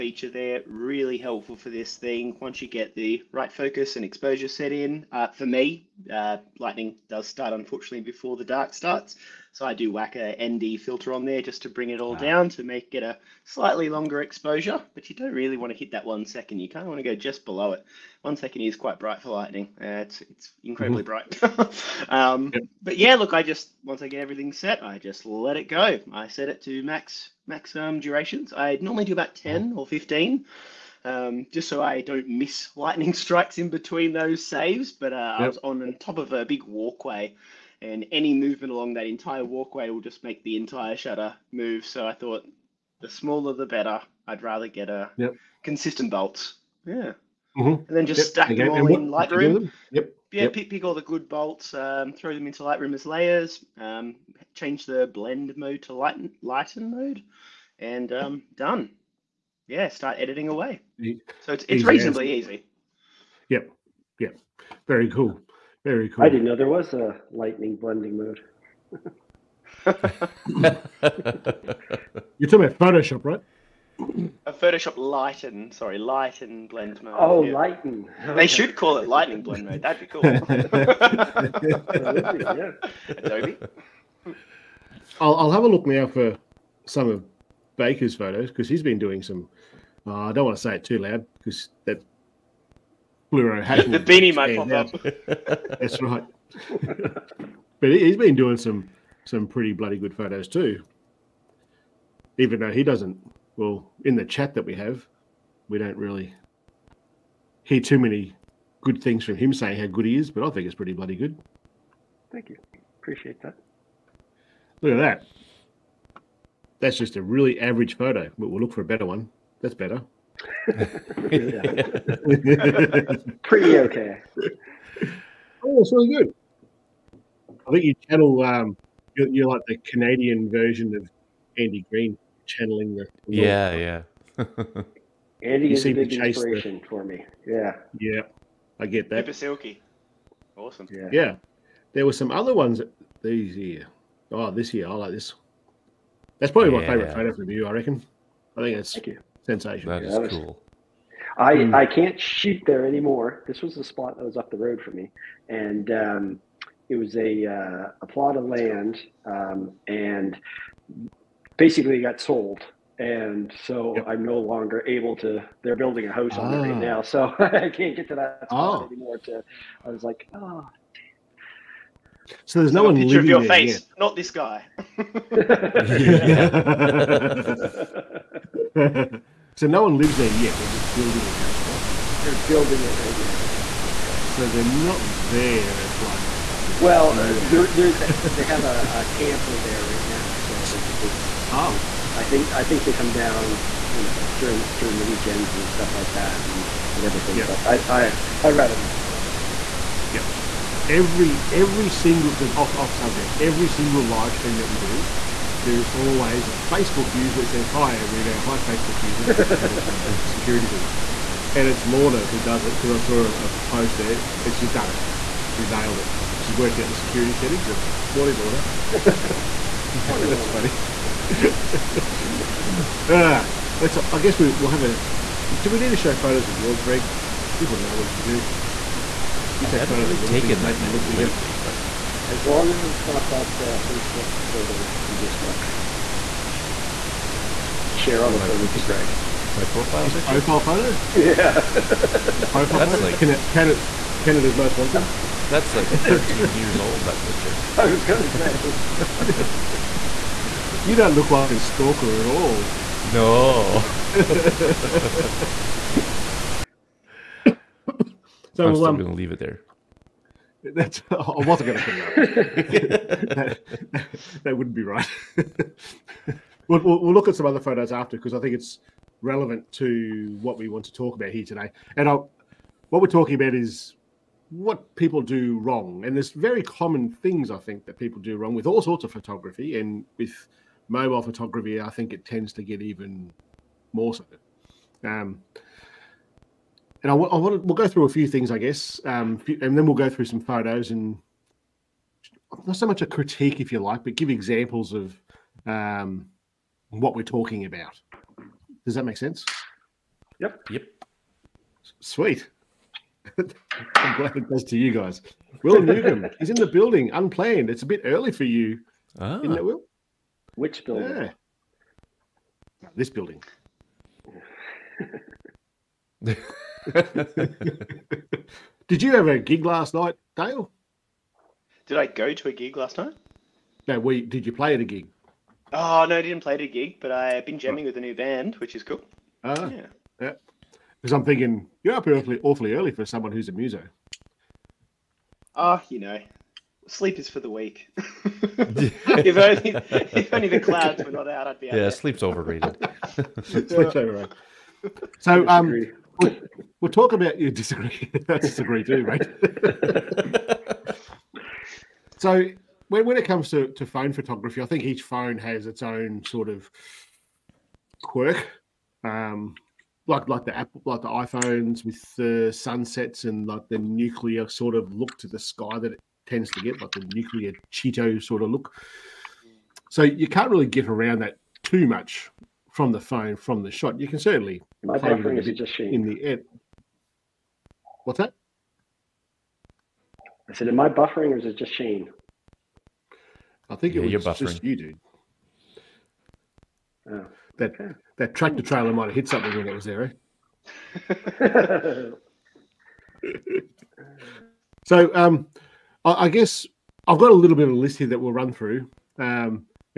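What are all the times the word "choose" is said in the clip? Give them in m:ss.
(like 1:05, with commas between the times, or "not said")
not said.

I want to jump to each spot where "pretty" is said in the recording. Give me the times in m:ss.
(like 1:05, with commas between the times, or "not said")
1:39, 1:50, 2:00.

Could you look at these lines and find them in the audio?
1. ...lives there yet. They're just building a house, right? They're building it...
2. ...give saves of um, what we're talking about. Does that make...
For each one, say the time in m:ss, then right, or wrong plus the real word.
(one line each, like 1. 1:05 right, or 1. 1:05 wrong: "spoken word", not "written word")
1. 2:59 right
2. 4:54 wrong: "examples", not "saves".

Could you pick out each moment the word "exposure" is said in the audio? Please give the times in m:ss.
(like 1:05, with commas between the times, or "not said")
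0:04, 0:14.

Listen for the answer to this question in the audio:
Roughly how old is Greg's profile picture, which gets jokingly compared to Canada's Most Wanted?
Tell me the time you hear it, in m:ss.
4:05.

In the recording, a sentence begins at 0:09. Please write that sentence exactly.
So I do whack a ND filter on there just to bring it all ah.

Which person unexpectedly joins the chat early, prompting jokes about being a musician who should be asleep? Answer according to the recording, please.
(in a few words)
Will Newcomb.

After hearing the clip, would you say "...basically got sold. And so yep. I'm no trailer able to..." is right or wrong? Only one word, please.
wrong.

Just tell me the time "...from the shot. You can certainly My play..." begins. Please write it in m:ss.
6:13.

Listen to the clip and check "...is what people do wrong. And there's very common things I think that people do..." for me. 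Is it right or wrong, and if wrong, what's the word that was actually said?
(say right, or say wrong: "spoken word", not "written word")
right.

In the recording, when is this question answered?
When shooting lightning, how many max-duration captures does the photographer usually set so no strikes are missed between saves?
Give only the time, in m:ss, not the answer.
0:29.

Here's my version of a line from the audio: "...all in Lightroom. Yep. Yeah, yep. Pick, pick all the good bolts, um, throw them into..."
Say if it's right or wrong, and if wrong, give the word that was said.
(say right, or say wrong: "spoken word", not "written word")
right.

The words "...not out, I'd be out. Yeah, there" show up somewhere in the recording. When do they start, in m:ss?
5:41.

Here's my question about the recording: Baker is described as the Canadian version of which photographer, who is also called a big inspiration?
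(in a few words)
Andy Green.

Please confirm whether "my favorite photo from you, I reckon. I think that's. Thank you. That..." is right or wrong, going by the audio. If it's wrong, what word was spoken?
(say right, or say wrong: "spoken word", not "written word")
right.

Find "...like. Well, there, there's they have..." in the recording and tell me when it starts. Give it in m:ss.
3:06.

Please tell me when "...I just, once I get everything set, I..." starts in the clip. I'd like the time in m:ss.
0:23.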